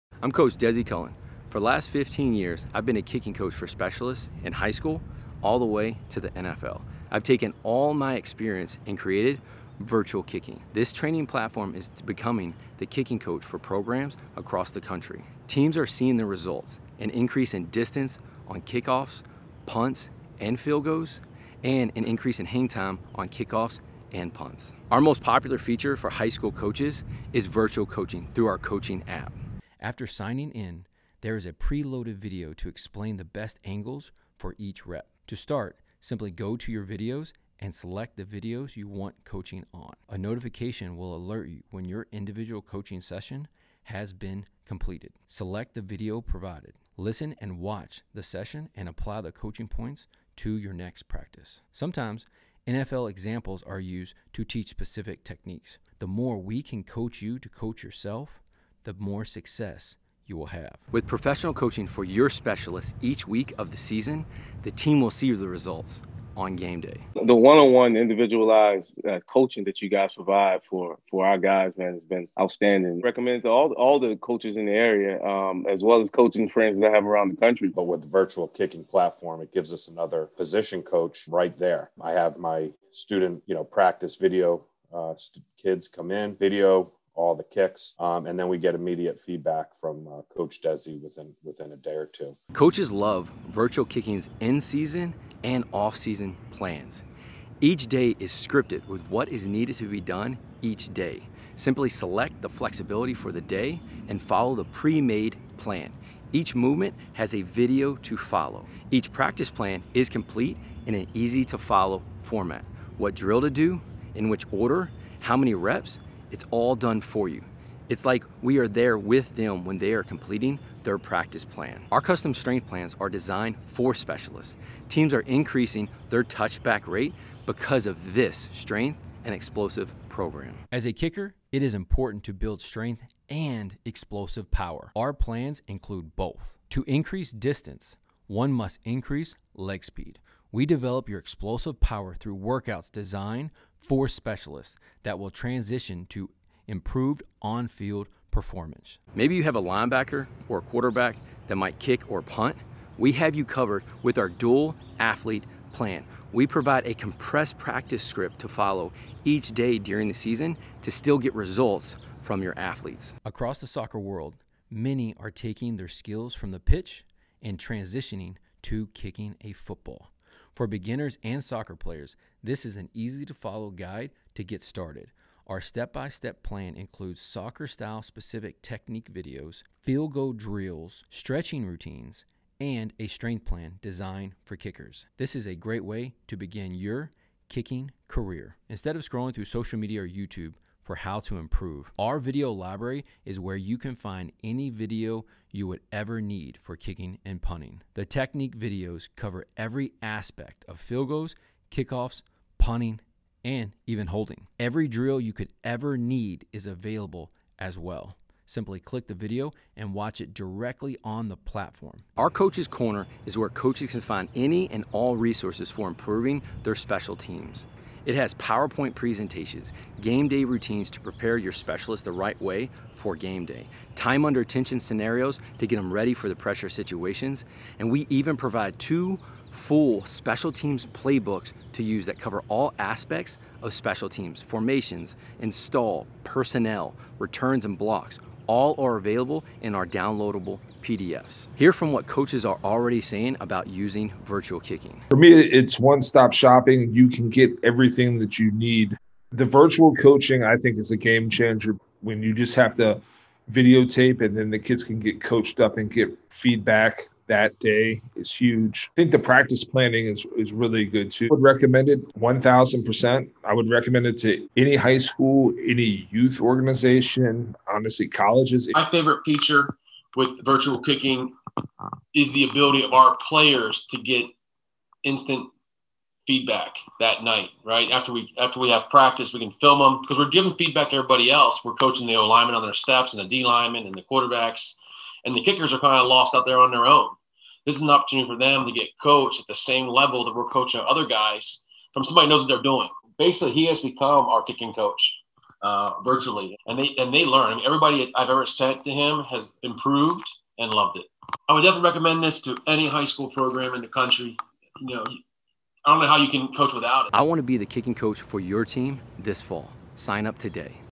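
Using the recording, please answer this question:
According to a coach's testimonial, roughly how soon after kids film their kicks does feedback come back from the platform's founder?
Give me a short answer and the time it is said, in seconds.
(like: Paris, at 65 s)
a day or two, at 91 s.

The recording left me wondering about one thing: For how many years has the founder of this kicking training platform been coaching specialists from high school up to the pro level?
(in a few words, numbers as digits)
15.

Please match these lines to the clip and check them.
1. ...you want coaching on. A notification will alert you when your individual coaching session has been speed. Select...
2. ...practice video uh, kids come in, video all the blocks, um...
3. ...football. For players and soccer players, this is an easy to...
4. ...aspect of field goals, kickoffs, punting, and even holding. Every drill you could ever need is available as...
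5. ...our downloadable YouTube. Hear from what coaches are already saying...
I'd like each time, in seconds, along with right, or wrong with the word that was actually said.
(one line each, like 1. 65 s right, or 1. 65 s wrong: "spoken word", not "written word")
1. 38 s wrong: "completed", not "speed"
2. 83 s wrong: "kicks", not "blocks"
3. 169 s wrong: "beginners", not "players"
4. 200 s right
5. 239 s wrong: "PDFs", not "YouTube".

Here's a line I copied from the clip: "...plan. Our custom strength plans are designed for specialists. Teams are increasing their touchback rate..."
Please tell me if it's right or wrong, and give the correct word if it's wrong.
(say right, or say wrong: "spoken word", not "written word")
right.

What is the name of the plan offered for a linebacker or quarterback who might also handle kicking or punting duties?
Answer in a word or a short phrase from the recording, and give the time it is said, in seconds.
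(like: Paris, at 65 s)
dual athlete plan, at 154 s.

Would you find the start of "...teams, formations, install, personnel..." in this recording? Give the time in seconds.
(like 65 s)
234 s.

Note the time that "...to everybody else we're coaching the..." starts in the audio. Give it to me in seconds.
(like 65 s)
280 s.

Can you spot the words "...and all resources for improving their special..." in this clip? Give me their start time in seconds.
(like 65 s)
214 s.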